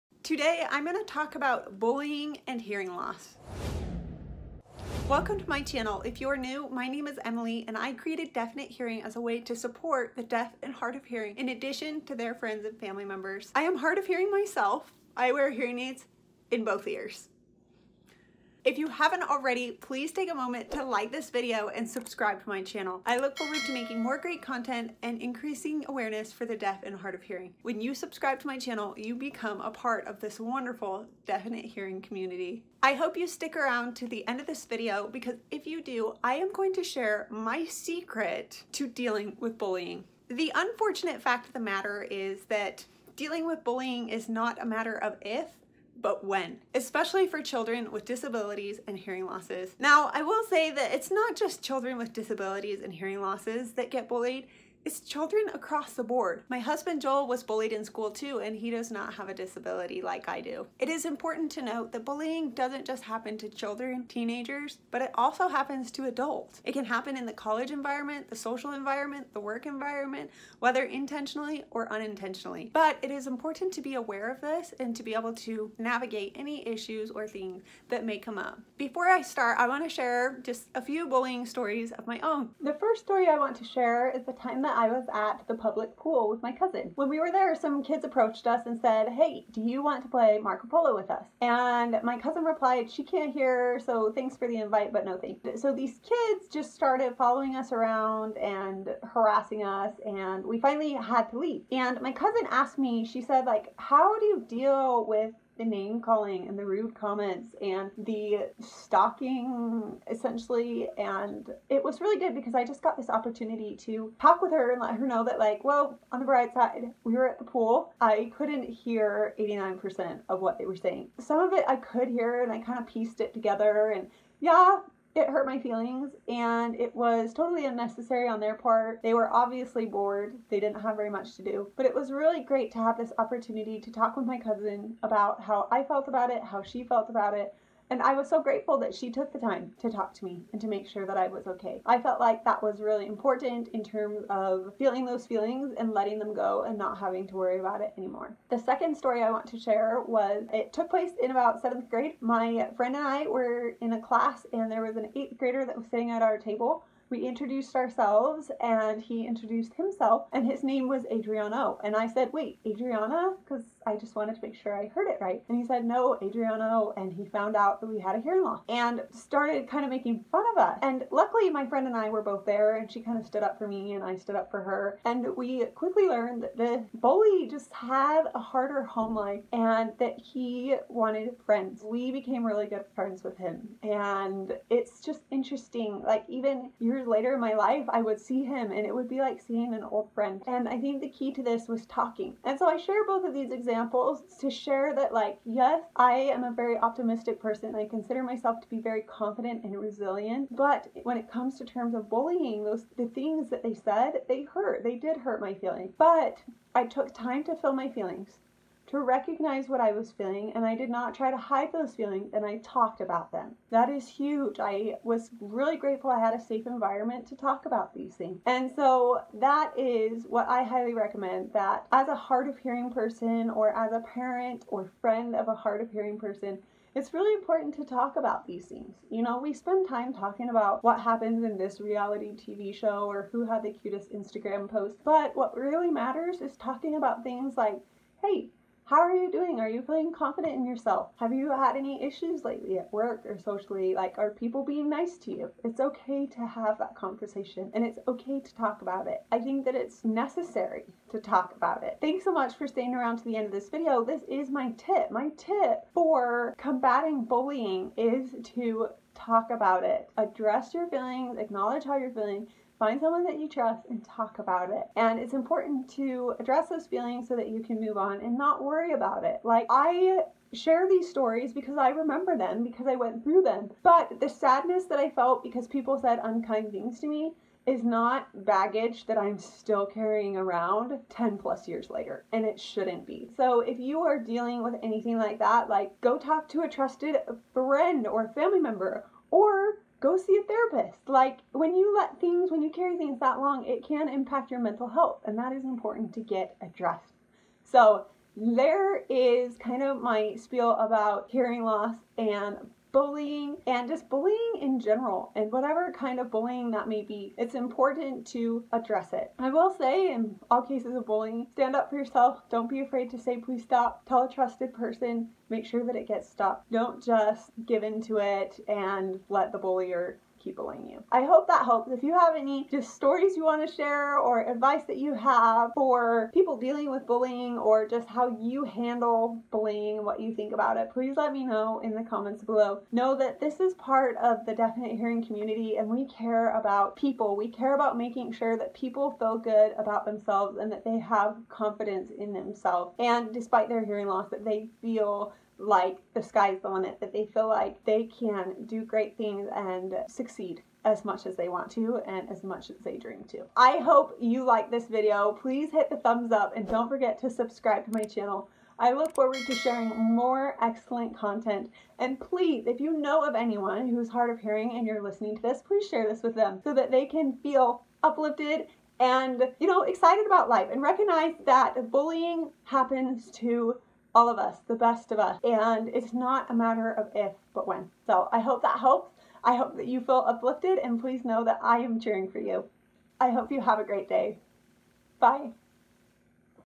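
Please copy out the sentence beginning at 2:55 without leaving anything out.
And we quickly learned that the bully just had a harder home life and that he wanted friends.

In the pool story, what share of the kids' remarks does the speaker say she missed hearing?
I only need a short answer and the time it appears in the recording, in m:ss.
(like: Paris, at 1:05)
89%, at 1:59.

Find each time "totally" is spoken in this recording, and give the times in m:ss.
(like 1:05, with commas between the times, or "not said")
2:07.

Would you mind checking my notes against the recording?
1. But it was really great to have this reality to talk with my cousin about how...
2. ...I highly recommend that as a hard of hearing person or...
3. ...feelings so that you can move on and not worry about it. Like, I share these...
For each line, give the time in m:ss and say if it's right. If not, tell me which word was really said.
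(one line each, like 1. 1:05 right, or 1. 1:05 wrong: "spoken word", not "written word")
1. 2:11 wrong: "opportunity", not "reality"
2. 3:40 right
3. 4:26 right.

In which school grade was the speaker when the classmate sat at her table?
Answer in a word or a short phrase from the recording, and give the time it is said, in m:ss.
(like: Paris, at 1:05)
seventh grade, at 2:31.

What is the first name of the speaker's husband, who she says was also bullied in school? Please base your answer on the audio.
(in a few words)
Joel.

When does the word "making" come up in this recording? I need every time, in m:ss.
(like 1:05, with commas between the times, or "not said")
0:23, 2:49, 5:37.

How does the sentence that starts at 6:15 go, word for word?
And it's not a matter of if, but when.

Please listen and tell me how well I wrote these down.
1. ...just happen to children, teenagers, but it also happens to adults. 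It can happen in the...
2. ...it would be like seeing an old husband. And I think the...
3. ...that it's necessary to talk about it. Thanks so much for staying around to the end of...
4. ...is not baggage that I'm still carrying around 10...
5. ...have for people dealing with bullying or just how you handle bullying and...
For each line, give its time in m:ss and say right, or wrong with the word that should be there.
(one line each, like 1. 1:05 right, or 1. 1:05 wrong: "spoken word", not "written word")
1. 1:02 right
2. 3:08 wrong: "friend", not "husband"
3. 4:09 right
4. 4:37 right
5. 5:25 right.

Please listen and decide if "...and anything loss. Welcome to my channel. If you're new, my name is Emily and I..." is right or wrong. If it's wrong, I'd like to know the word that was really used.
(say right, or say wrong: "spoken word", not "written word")
wrong: "hearing", not "anything".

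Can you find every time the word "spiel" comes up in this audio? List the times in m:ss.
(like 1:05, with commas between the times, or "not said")
5:00.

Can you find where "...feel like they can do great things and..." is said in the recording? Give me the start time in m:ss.
5:47.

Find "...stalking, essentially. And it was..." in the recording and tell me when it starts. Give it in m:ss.
1:48.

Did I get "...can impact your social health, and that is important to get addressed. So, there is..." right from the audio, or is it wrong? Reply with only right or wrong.
wrong.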